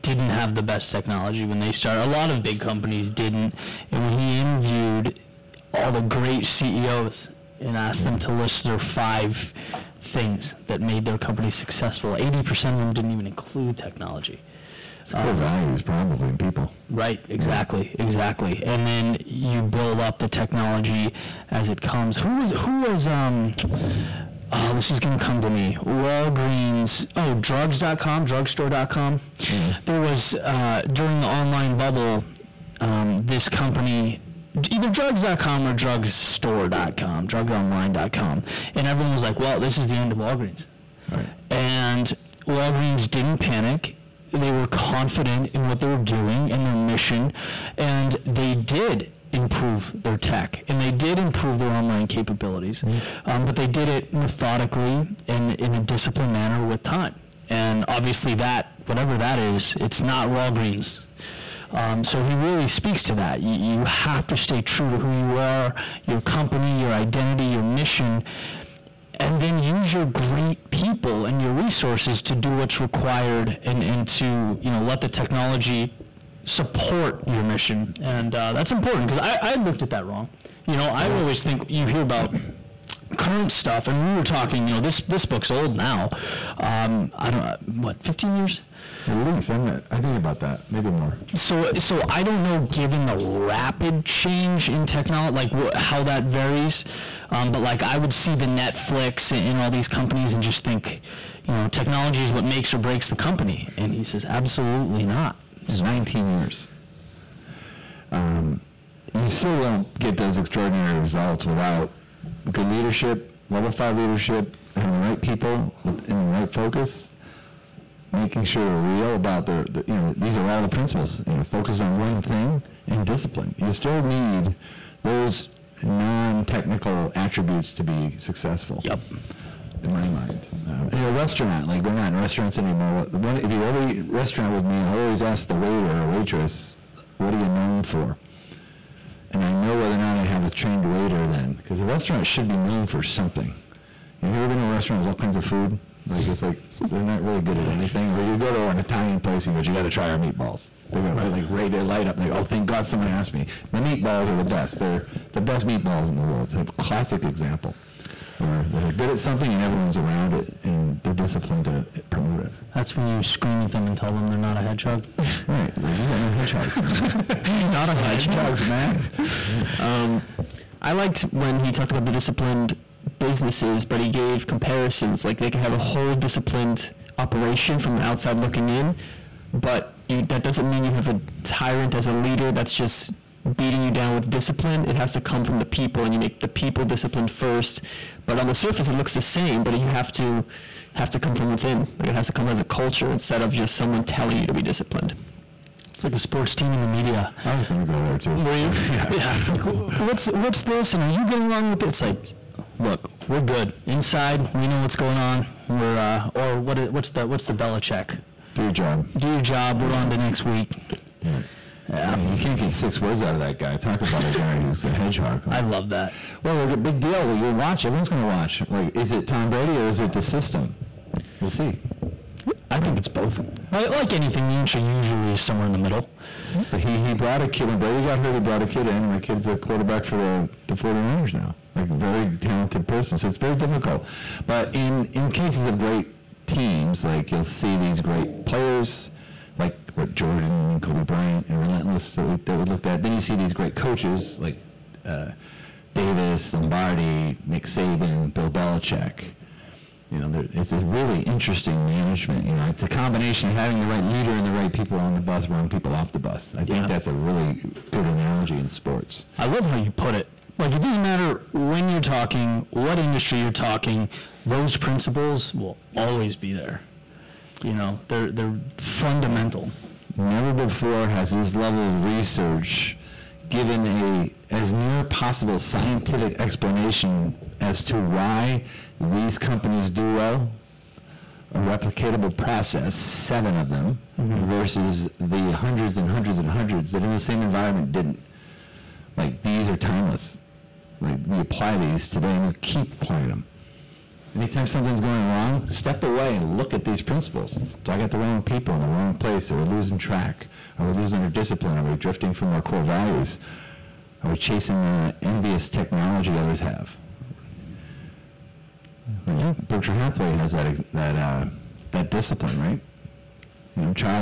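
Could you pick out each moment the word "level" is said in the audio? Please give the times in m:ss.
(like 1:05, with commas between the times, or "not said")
1:53, 4:31.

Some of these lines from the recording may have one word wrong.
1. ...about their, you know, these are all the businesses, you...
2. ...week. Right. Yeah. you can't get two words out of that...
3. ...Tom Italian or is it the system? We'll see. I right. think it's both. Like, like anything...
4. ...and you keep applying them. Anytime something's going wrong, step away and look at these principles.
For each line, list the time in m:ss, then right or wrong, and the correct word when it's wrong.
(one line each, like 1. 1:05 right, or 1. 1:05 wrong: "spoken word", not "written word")
1. 1:59 wrong: "principles", not "businesses"
2. 3:30 wrong: "six", not "two"
3. 3:39 wrong: "Brady", not "Italian"
4. 4:52 right.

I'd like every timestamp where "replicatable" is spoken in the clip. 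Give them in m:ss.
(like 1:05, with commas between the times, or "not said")
4:41.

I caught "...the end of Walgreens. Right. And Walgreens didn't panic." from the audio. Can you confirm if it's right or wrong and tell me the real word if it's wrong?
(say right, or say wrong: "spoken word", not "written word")
right.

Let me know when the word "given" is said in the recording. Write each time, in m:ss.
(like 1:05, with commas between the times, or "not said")
1:32, 4:33.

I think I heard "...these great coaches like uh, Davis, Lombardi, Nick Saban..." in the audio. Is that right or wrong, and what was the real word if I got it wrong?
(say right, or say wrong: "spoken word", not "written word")
right.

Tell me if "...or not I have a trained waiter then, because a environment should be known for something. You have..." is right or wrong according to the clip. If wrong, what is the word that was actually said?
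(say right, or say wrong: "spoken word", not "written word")
wrong: "restaurant", not "environment".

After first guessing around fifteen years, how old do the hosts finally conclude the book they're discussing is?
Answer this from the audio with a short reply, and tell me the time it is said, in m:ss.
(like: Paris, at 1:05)
19 years, at 1:45.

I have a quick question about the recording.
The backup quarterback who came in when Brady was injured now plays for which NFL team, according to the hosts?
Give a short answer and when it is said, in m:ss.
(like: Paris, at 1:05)
49ers, at 3:50.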